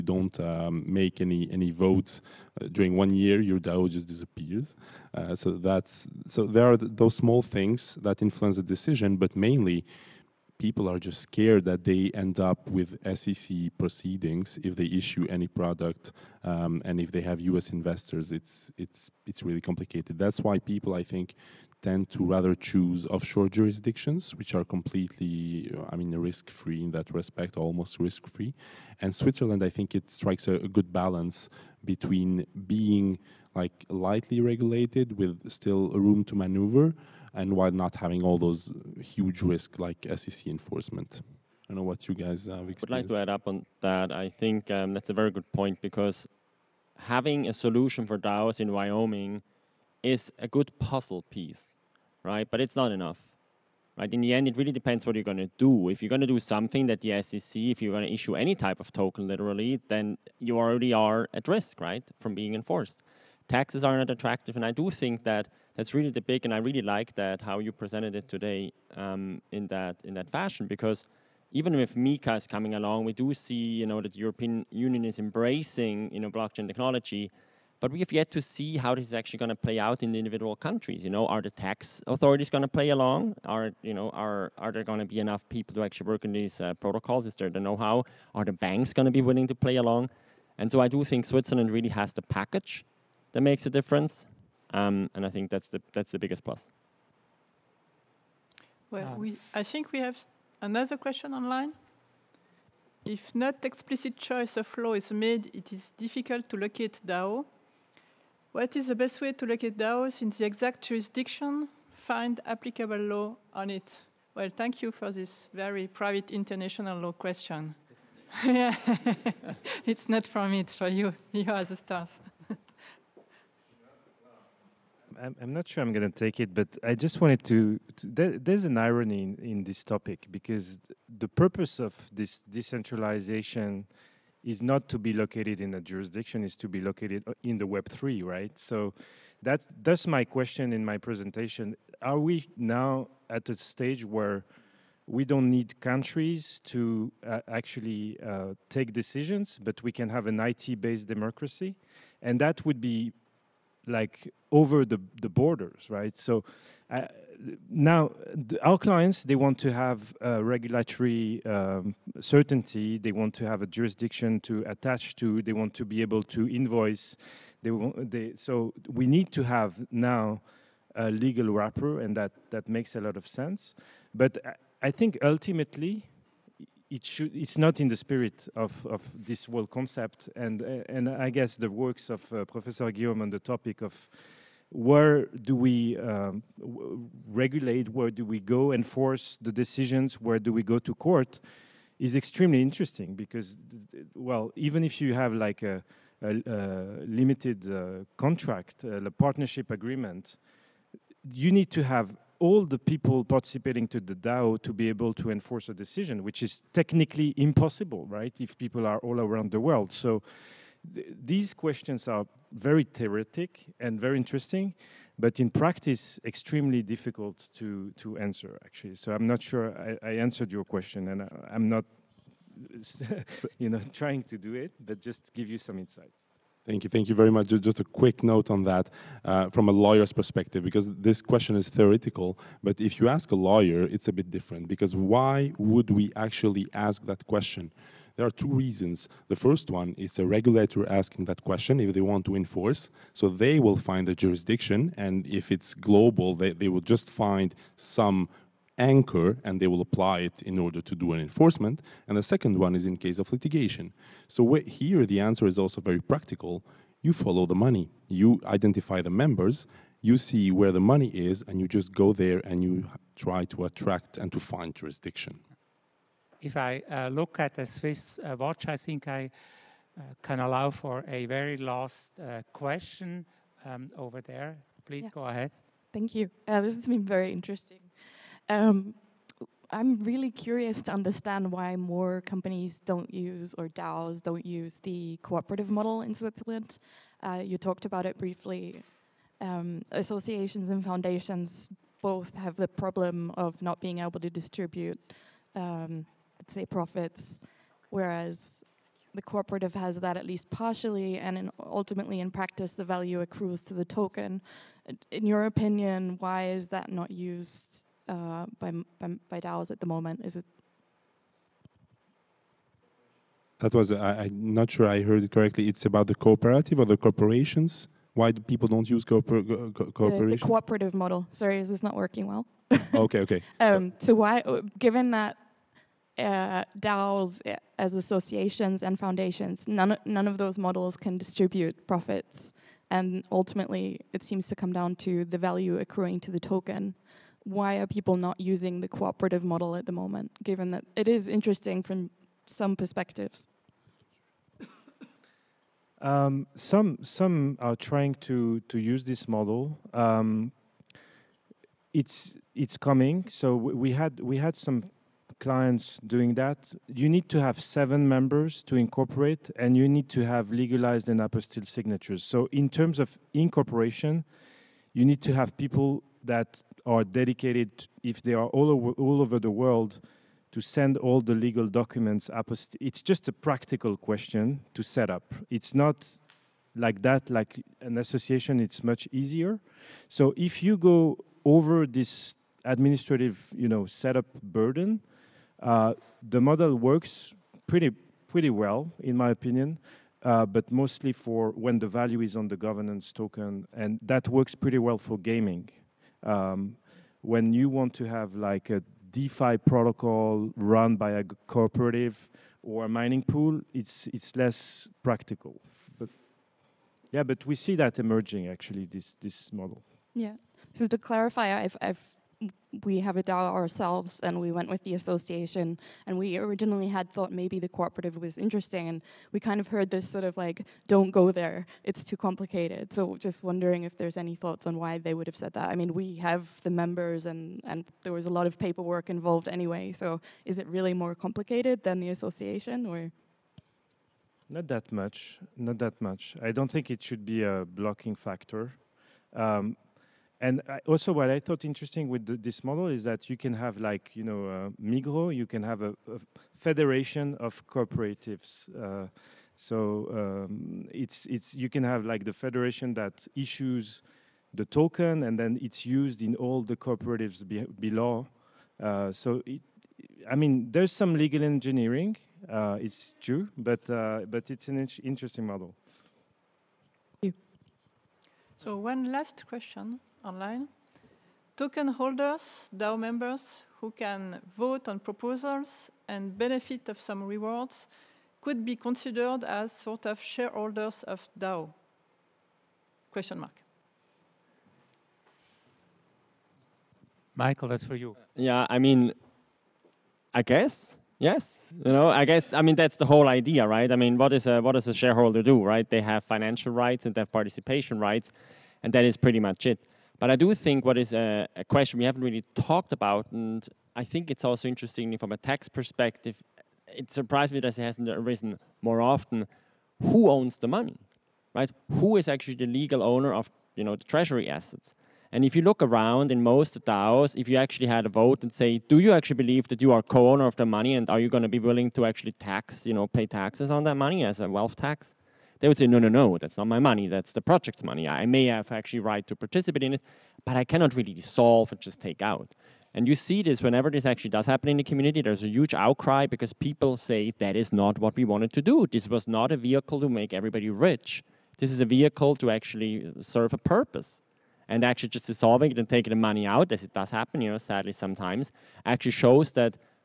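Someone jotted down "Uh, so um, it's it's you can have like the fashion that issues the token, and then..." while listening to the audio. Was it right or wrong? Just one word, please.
wrong.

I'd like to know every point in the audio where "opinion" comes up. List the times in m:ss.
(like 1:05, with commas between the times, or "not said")
5:05, 6:29.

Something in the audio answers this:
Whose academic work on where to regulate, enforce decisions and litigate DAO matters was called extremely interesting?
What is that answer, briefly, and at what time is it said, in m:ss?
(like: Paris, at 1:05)
Professor Guillaume, at 3:02.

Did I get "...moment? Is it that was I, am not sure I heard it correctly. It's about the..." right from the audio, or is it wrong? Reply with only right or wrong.
right.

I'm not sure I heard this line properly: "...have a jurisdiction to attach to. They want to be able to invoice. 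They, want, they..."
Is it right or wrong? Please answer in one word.
right.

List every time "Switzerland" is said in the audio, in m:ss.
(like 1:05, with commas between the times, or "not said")
0:29, 1:31, 4:46.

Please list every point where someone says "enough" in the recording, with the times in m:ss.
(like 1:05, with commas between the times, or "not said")
0:52, 1:25.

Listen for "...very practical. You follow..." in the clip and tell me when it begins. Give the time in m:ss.
4:15.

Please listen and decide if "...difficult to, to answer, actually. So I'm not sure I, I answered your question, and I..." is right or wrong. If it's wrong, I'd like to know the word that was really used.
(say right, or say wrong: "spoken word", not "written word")
right.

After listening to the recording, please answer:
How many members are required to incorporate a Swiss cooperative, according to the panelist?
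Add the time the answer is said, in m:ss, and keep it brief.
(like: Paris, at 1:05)
7, at 5:57.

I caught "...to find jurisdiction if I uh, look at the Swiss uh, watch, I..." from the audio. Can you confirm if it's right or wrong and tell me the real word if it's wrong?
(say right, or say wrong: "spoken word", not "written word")
right.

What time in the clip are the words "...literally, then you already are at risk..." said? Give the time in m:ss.
0:59.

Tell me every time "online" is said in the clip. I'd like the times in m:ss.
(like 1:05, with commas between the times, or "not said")
1:41, 7:50.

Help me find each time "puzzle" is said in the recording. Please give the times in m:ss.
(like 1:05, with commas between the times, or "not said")
0:50.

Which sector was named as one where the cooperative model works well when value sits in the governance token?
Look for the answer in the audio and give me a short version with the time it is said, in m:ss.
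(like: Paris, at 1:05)
gaming, at 6:35.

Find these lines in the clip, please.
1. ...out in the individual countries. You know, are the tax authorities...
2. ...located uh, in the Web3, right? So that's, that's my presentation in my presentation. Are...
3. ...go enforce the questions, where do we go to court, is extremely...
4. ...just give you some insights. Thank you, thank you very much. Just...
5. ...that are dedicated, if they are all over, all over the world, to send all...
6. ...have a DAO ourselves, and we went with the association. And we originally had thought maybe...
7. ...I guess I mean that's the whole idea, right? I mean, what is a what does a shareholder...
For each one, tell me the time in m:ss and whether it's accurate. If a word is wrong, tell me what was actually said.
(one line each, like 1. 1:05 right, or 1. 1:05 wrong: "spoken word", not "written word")
1. 1:19 right
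2. 2:16 wrong: "question", not "presentation"
3. 3:08 wrong: "decisions", not "questions"
4. 3:44 right
5. 6:06 right
6. 6:52 right
7. 8:12 right.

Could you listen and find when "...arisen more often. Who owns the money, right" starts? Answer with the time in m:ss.
8:28.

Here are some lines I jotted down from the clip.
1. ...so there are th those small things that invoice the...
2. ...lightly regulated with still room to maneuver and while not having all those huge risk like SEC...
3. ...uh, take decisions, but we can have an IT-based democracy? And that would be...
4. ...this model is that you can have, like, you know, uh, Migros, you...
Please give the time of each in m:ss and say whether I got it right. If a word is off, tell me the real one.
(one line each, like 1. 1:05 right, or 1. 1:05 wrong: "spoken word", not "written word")
1. 0:06 wrong: "influence", not "invoice"
2. 0:33 right
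3. 2:28 right
4. 7:22 right.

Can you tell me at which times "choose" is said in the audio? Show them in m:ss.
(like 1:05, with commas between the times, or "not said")
0:22.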